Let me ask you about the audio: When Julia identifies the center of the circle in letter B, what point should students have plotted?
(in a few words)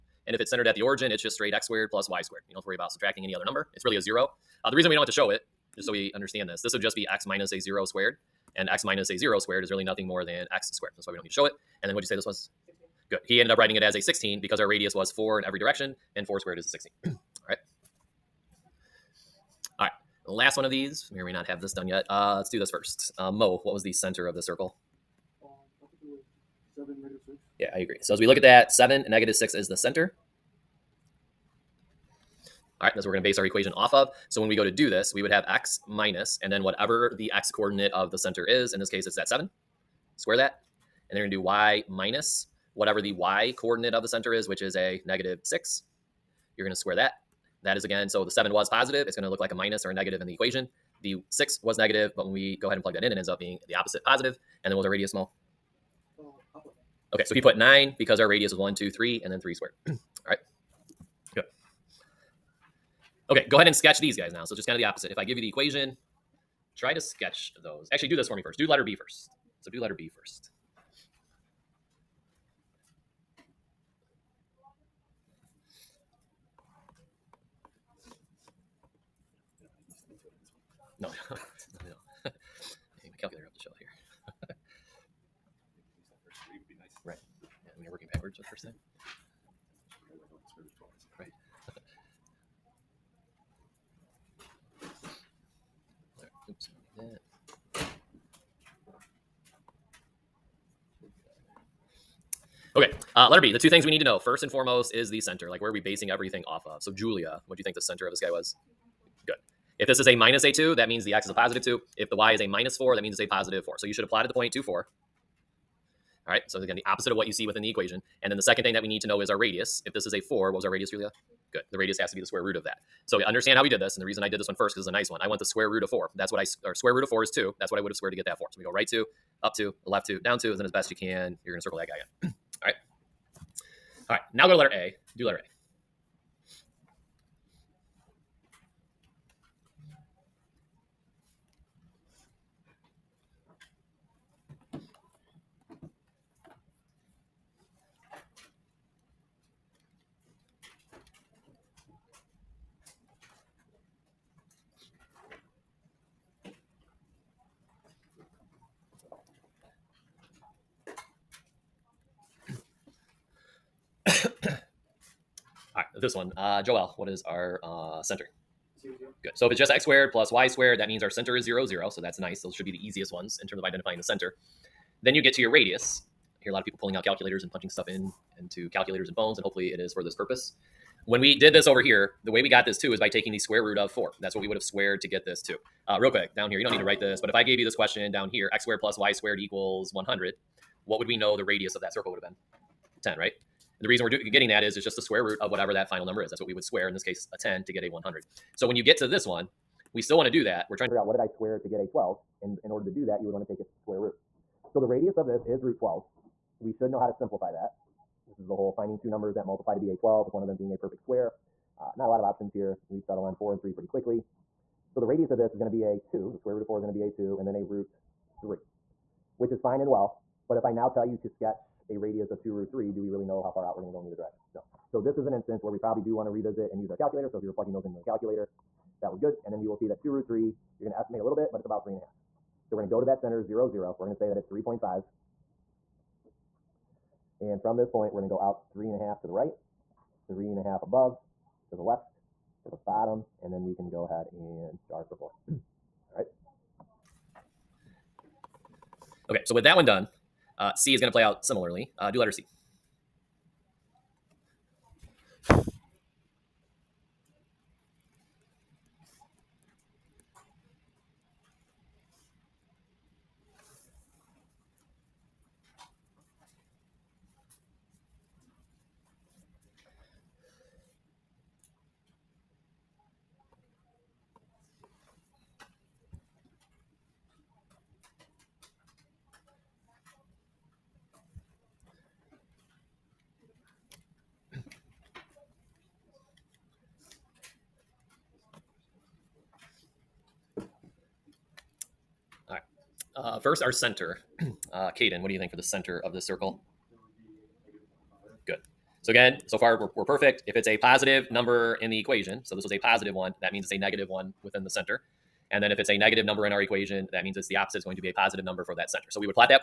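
2, 4.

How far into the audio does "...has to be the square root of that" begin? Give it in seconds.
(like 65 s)
121 s.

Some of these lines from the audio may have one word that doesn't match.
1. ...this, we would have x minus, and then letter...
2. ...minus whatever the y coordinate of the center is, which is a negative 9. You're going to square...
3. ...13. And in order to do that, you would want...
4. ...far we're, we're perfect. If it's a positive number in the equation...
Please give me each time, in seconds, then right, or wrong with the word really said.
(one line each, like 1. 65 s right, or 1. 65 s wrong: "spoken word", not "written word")
1. 34 s wrong: "whatever", not "letter"
2. 41 s wrong: "6", not "9"
3. 201 s wrong: "12", not "13"
4. 299 s right.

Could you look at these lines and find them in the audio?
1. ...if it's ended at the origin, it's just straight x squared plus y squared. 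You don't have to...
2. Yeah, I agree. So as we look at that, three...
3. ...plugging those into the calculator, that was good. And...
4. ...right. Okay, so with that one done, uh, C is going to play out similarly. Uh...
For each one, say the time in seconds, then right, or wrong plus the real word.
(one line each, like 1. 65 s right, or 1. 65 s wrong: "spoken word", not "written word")
1. 0 s wrong: "centered", not "ended"
2. 27 s wrong: "seven", not "three"
3. 227 s right
4. 246 s right.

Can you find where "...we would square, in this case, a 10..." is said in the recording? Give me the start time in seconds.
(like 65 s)
196 s.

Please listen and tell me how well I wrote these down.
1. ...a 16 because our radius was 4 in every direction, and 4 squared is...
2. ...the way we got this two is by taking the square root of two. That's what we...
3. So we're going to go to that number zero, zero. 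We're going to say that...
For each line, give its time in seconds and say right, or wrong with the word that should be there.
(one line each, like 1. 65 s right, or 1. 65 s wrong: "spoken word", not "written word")
1. 13 s right
2. 182 s wrong: "four", not "two"
3. 232 s wrong: "center", not "number".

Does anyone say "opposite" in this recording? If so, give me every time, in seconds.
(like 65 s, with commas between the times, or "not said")
53 s, 64 s, 116 s, 307 s.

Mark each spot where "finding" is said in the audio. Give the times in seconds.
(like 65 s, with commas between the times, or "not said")
208 s.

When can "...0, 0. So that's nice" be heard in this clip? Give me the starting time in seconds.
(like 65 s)
171 s.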